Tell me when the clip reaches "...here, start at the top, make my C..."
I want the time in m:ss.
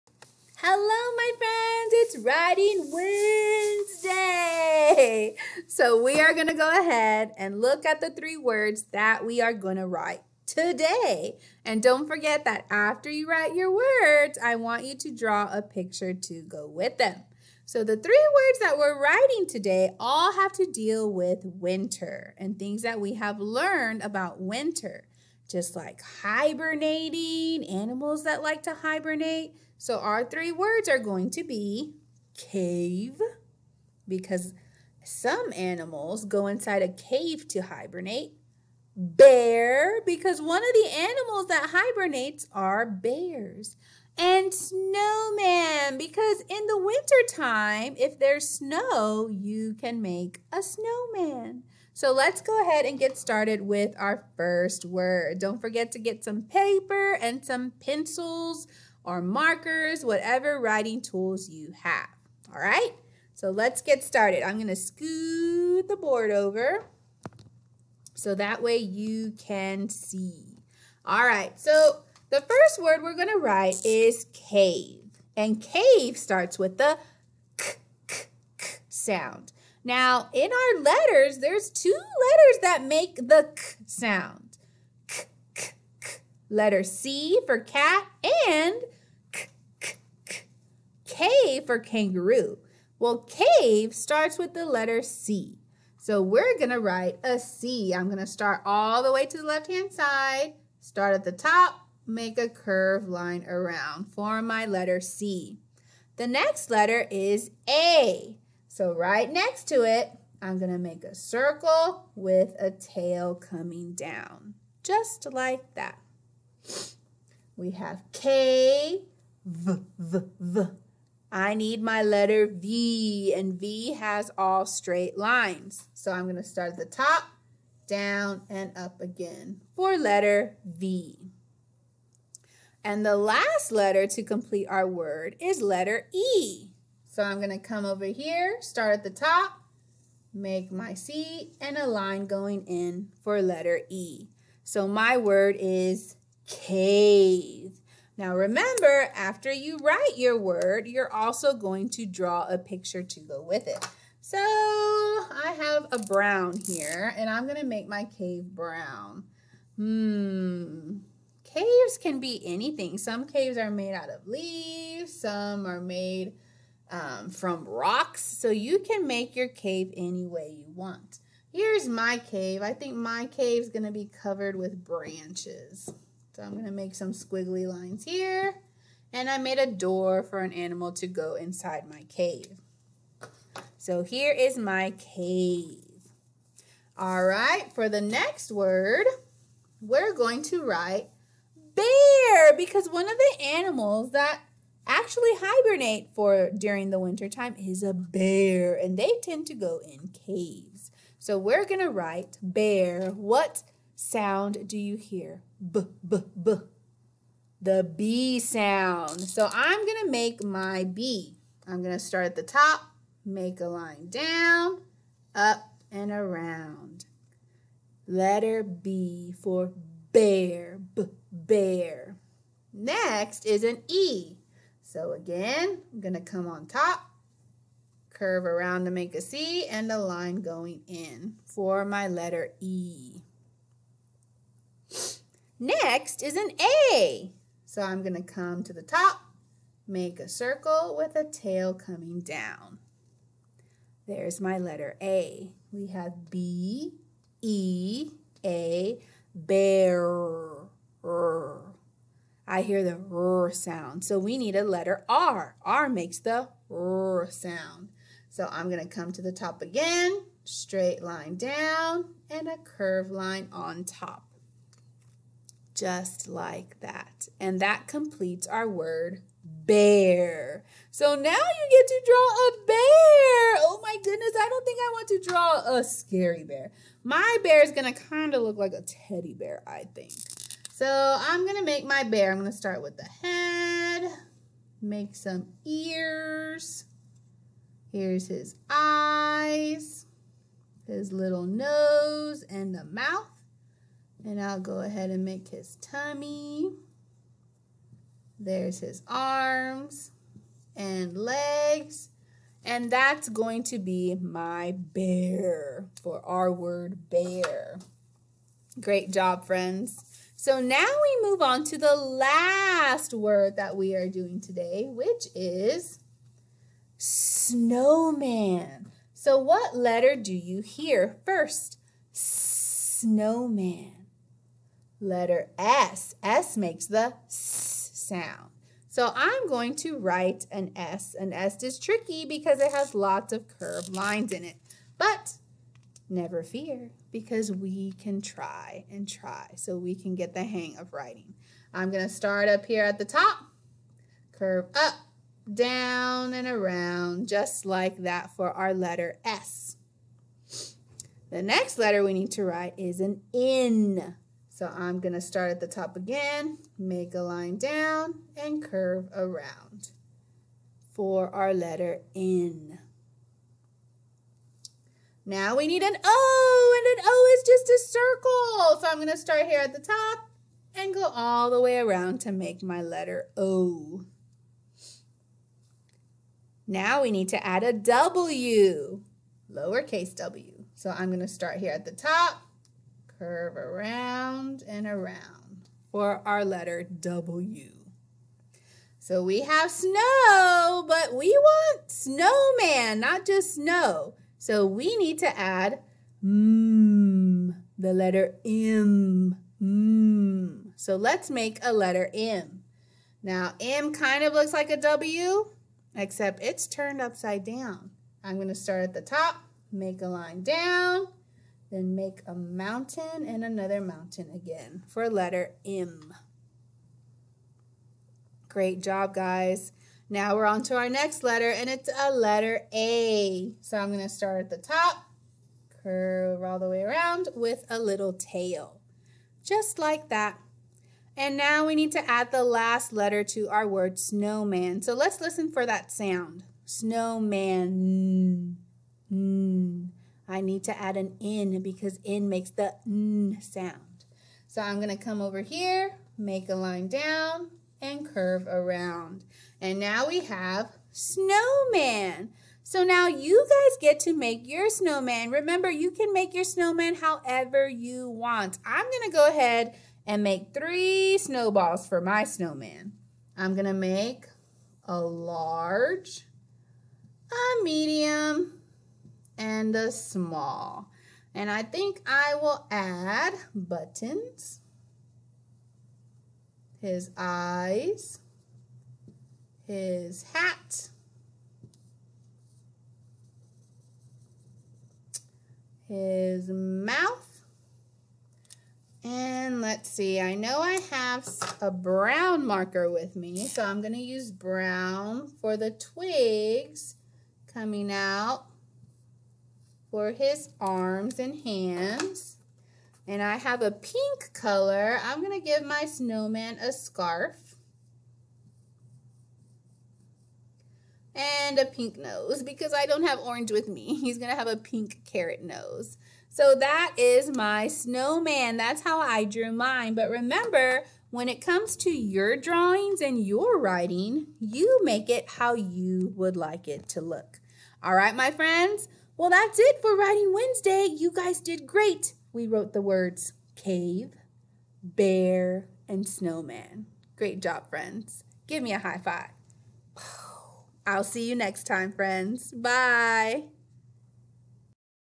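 2:18.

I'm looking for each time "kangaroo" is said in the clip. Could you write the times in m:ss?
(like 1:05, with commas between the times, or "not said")
1:31.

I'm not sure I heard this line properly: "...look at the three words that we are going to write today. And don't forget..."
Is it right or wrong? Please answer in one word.
right.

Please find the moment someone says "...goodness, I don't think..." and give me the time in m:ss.
4:34.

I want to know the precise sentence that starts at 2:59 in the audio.
And I made a door for an animal to go inside my cave.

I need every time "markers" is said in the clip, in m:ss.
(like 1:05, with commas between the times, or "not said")
0:59, 8:12.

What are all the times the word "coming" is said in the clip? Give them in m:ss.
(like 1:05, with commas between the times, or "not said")
1:53, 4:01, 8:17.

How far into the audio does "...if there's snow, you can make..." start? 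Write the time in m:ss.
0:47.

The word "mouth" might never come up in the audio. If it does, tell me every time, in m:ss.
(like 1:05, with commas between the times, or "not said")
4:52, 8:06.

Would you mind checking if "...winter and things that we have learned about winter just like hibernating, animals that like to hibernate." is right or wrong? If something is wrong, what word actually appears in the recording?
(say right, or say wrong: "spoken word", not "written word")
right.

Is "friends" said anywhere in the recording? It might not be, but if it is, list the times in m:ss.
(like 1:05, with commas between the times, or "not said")
0:01, 5:09, 8:48, 8:57, 9:01.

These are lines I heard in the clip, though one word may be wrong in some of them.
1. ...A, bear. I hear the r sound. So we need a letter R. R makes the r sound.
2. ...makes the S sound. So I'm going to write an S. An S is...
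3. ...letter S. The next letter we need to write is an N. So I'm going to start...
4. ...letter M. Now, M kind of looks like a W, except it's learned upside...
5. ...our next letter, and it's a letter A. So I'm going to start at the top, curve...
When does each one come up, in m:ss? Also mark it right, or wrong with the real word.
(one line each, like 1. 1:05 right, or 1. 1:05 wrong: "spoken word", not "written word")
1. 4:08 right
2. 5:26 right
3. 5:48 right
4. 6:41 wrong: "turned", not "learned"
5. 7:00 right.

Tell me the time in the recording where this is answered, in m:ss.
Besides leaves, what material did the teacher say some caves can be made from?
2:47.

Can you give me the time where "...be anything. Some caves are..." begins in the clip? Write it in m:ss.
2:42.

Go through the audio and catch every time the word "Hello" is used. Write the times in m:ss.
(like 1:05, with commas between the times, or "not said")
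0:00.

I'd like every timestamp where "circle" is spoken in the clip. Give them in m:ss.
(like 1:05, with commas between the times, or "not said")
1:51, 4:00, 6:07.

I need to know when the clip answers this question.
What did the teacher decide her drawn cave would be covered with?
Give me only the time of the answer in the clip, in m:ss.
2:54.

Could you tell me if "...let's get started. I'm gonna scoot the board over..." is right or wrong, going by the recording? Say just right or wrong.
right.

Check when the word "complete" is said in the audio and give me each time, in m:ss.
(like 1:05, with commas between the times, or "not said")
2:14, 4:27.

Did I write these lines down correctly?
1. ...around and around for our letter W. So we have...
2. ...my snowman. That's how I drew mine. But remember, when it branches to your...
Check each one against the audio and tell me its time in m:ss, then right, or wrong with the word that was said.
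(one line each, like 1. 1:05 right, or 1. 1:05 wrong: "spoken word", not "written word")
1. 6:23 right
2. 8:37 wrong: "comes", not "branches".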